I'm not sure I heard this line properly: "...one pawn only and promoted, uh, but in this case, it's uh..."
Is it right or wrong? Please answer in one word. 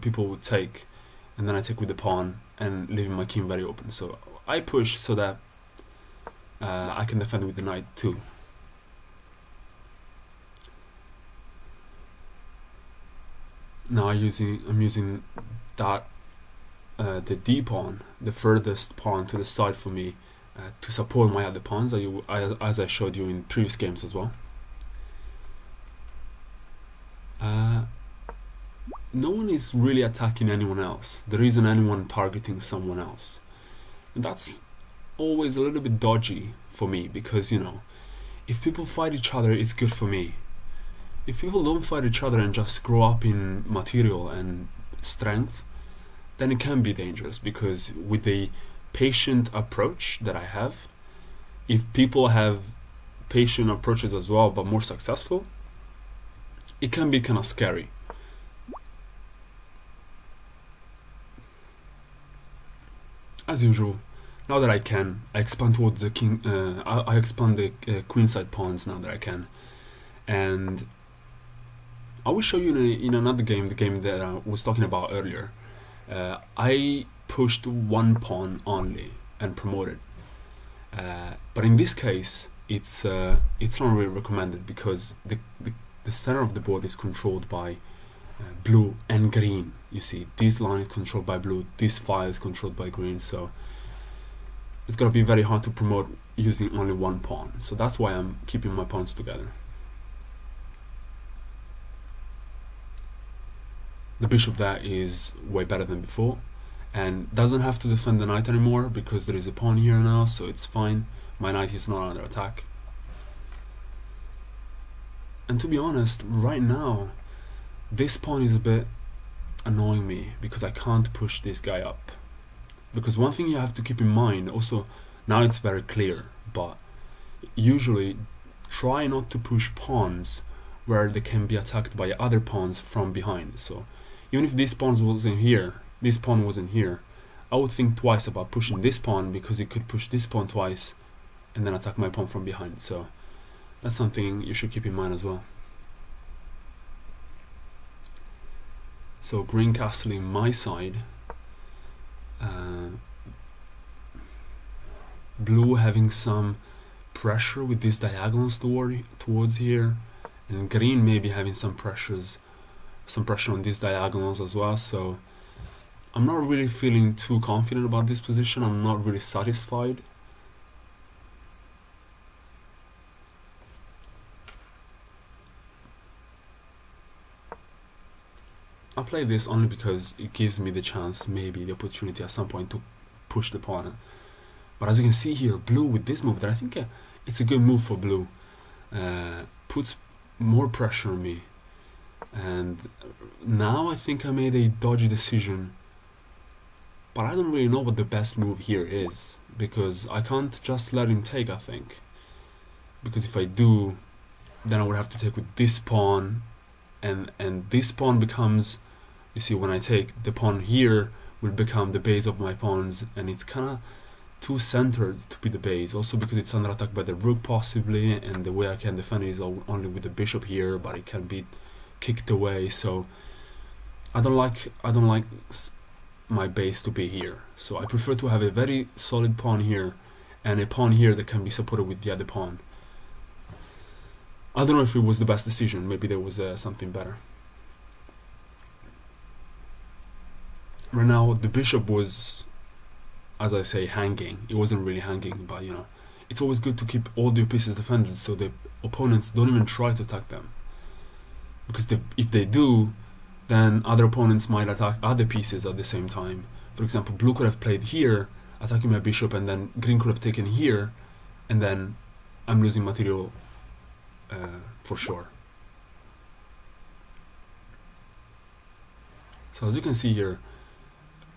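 right.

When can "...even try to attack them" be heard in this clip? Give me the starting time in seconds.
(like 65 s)
249 s.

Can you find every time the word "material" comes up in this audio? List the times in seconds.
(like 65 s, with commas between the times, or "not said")
43 s, 262 s.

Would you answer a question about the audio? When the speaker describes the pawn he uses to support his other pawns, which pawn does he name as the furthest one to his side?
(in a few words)
d pawn.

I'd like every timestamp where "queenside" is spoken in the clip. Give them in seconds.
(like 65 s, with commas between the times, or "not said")
68 s.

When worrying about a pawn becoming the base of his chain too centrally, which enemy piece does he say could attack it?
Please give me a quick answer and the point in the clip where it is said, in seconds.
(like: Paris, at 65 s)
the rook, at 217 s.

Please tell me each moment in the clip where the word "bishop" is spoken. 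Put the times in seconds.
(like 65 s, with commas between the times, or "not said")
104 s, 220 s, 241 s, 258 s.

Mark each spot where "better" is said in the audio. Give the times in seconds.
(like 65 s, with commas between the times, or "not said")
105 s, 236 s.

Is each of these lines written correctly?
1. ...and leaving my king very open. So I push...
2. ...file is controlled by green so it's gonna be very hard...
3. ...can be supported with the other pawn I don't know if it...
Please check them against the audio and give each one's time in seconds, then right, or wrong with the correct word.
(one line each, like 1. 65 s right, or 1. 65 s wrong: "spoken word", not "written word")
1. 2 s right
2. 91 s right
3. 231 s right.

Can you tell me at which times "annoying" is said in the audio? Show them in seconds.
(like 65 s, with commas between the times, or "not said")
119 s.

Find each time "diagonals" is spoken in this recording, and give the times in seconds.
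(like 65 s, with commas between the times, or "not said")
157 s, 163 s.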